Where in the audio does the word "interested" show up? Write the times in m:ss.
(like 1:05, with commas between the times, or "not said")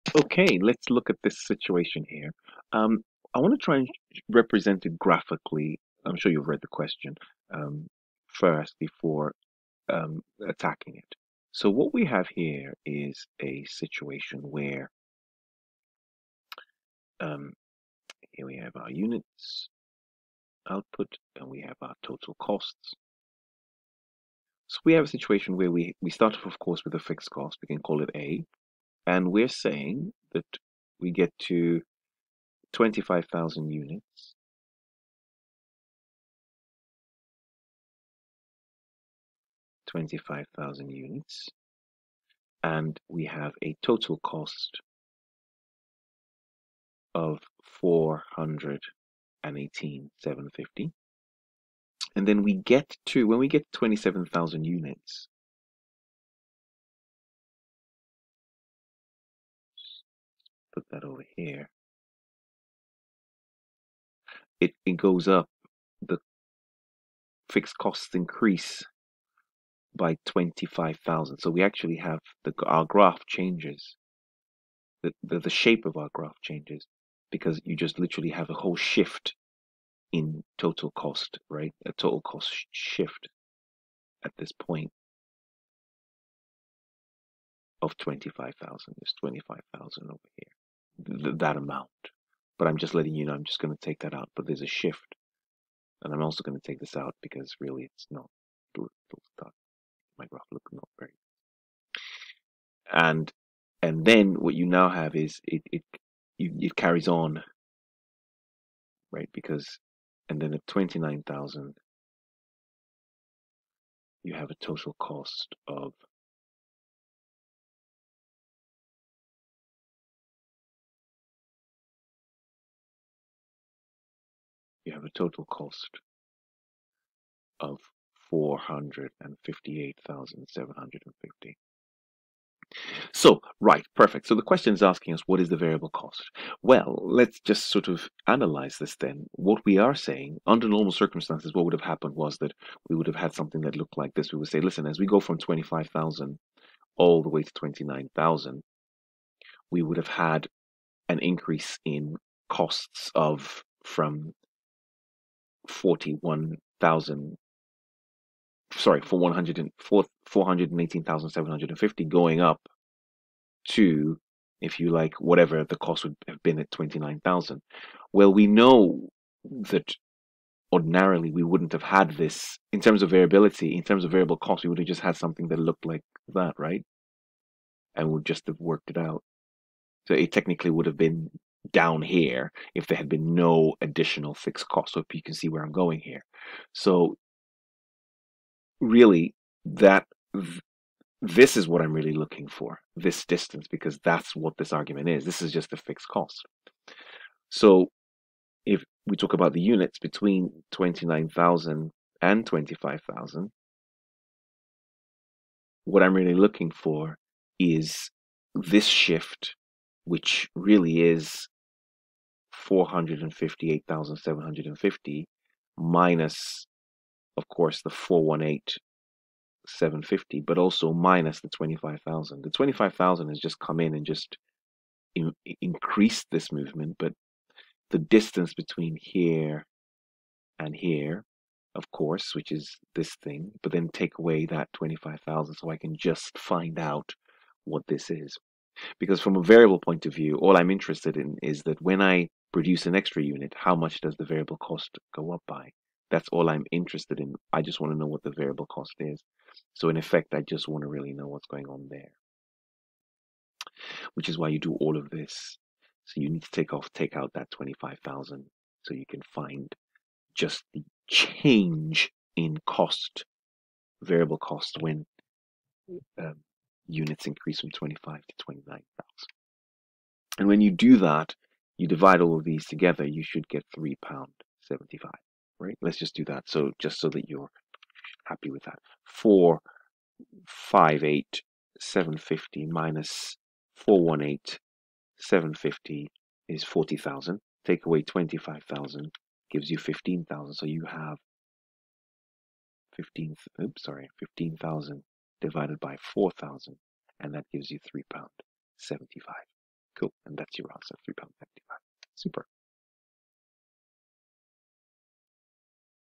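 4:00, 4:06.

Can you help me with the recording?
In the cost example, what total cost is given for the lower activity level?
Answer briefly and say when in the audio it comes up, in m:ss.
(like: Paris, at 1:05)
£418,750, at 0:47.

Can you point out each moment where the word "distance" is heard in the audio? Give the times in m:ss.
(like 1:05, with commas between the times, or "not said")
3:13, 3:47.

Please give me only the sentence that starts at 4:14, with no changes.
Which is why you do all of this.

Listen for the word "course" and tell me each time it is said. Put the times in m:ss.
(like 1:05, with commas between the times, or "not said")
0:26, 3:37, 3:51.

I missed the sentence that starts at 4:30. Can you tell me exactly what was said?
And when you do that, you divide all of these together, you should get £3.75, right?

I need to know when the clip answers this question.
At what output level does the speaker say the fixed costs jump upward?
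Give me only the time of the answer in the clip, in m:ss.
0:53.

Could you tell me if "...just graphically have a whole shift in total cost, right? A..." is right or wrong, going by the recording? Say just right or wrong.
wrong.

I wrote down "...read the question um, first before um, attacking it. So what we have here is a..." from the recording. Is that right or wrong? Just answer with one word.
right.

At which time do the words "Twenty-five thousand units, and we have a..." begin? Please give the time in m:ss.
0:39.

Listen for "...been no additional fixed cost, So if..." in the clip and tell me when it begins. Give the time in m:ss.
3:03.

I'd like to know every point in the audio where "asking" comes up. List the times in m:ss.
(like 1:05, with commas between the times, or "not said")
2:14.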